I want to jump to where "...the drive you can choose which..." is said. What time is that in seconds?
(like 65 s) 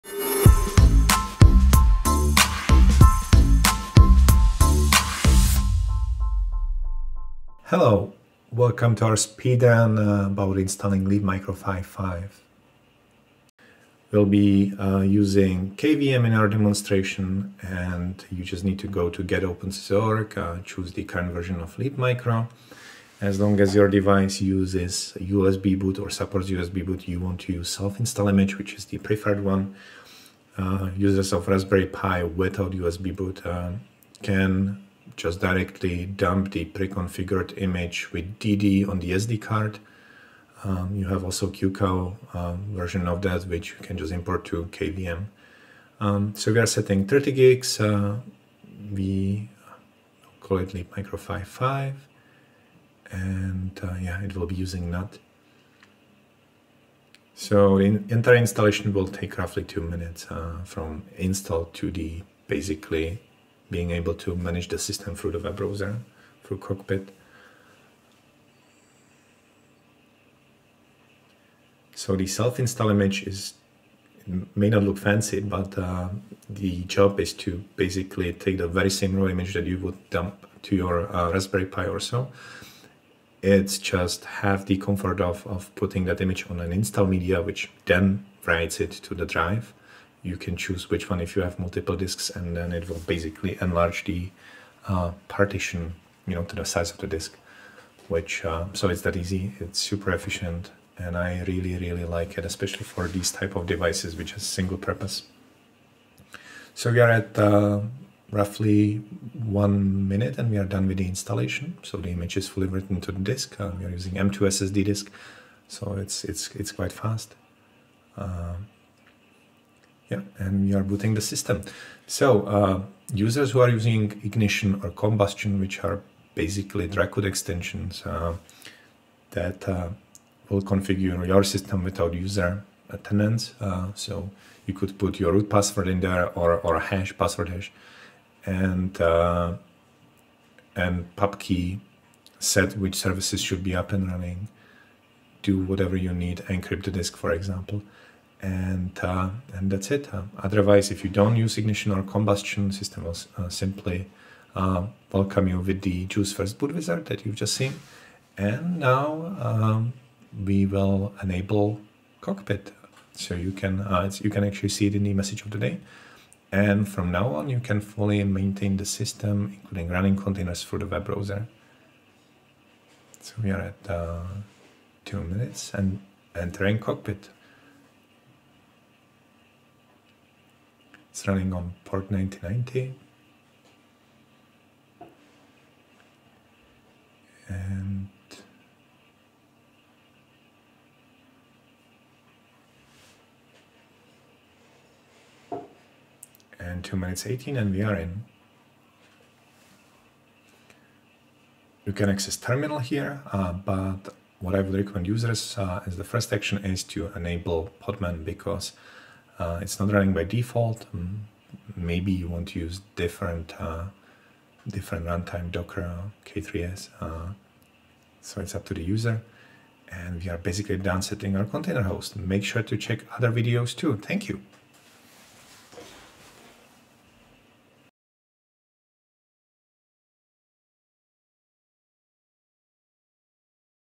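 89 s.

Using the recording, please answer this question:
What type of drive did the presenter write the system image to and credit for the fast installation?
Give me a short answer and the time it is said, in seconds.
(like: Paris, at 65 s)
M2 SSD, at 114 s.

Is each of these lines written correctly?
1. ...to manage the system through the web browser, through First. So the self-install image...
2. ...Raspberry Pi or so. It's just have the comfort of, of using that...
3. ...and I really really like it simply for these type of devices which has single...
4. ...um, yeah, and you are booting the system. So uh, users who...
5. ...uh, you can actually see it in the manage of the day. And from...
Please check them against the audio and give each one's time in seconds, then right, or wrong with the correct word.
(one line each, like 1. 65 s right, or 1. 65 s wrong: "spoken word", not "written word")
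1. 64 s wrong: "Cockpit", not "First"
2. 81 s wrong: "putting", not "using"
3. 100 s wrong: "especially", not "simply"
4. 118 s right
5. 163 s wrong: "message", not "manage".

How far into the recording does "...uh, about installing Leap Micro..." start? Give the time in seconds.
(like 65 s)
9 s.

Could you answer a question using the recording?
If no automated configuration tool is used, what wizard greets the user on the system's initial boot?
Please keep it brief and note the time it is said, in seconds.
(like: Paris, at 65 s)
JeOS First Boot Wizard, at 156 s.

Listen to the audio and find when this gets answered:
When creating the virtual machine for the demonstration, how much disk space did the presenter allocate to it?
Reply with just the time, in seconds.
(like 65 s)
47 s.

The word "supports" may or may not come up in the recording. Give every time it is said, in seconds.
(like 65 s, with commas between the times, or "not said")
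26 s.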